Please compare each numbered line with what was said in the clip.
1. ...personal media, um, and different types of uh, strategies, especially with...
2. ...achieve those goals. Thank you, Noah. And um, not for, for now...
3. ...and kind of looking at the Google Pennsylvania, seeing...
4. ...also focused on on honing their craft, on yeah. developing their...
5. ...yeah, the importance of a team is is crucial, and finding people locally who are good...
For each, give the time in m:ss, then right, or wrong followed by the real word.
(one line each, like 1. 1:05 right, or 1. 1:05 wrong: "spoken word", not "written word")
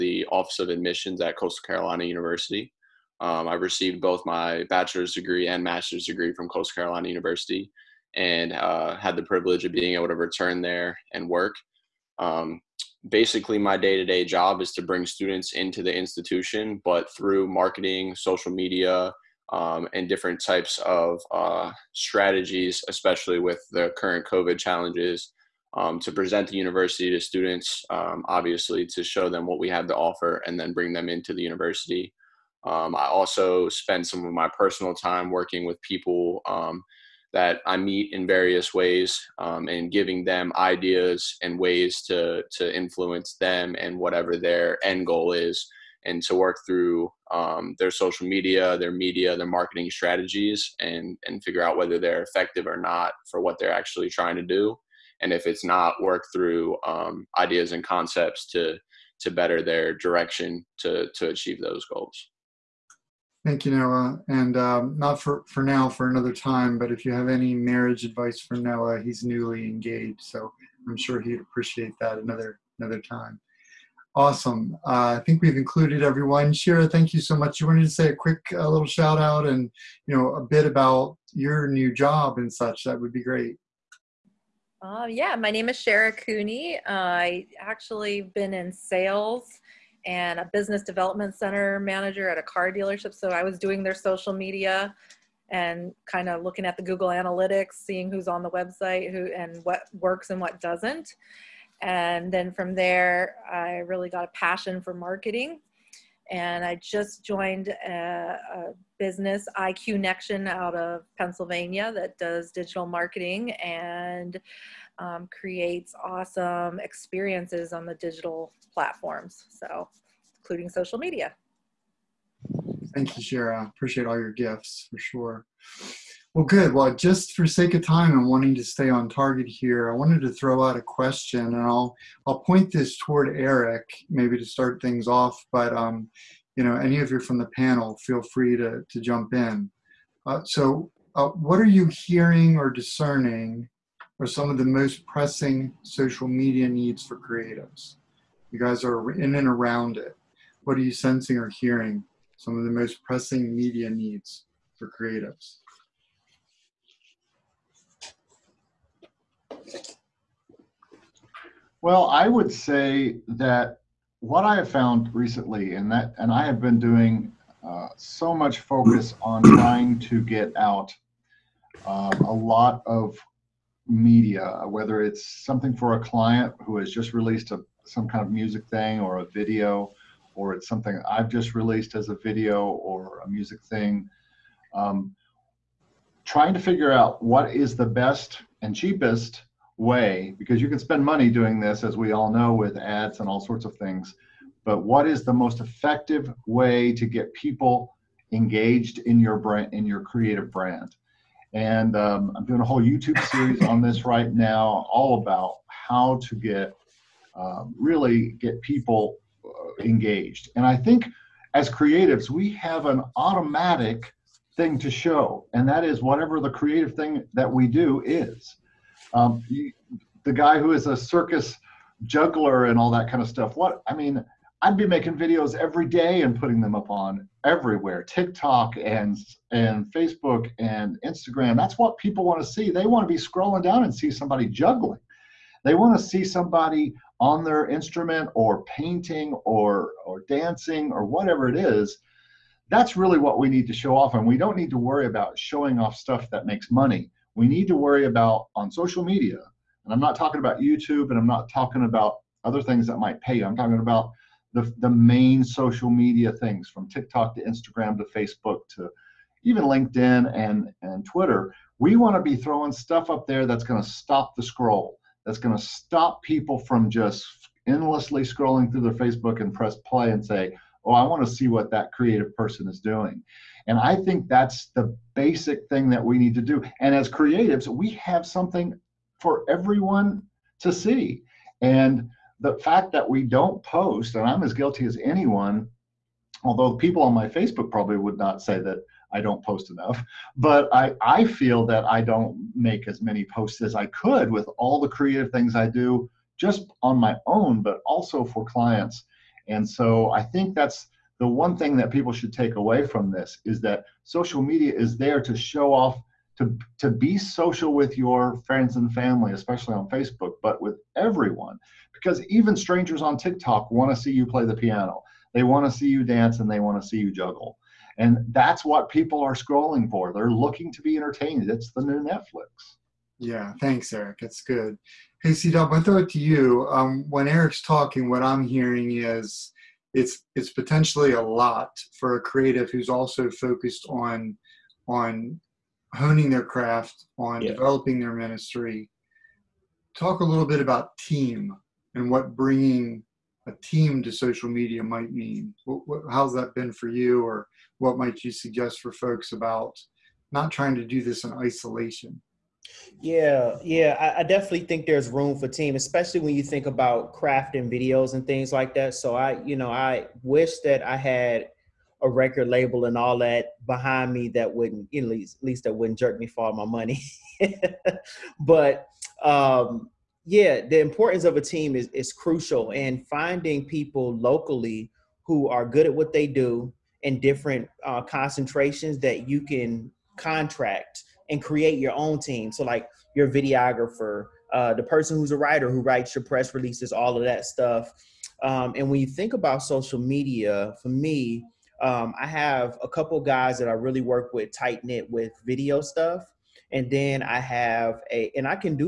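1. 0:18 wrong: "social", not "personal"
2. 1:01 right
3. 1:35 wrong: "Analytics", not "Pennsylvania"
4. 5:32 right
5. 6:10 right.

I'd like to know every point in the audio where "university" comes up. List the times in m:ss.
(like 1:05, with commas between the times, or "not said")
0:02, 0:07, 0:26, 0:31.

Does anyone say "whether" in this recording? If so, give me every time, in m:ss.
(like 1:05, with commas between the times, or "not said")
0:51, 2:54.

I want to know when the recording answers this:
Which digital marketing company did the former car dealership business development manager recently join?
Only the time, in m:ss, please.
1:49.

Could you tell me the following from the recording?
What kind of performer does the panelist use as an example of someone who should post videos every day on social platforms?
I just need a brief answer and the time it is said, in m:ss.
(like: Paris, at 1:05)
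circus juggler, at 3:40.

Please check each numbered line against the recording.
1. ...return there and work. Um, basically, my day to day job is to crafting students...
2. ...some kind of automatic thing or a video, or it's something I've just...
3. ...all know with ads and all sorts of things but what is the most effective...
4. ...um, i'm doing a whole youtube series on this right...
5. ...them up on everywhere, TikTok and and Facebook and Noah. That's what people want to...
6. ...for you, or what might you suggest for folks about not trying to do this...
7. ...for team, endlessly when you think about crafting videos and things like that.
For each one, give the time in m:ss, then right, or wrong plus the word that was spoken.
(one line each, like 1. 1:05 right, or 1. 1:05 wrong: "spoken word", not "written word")
1. 0:10 wrong: "bring", not "crafting"
2. 2:57 wrong: "music", not "automatic"
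3. 3:12 right
4. 3:21 right
5. 3:46 wrong: "Instagram", not "Noah"
6. 5:46 right
7. 5:55 wrong: "especially", not "endlessly".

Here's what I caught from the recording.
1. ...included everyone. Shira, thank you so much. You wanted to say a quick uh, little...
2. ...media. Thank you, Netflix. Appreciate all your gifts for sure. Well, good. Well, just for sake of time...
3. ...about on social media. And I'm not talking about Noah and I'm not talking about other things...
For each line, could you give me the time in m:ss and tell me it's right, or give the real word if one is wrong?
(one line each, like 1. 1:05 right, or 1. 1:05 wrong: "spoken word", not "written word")
1. 1:15 right
2. 2:00 wrong: "Shara", not "Netflix"
3. 4:08 wrong: "YouTube", not "Noah".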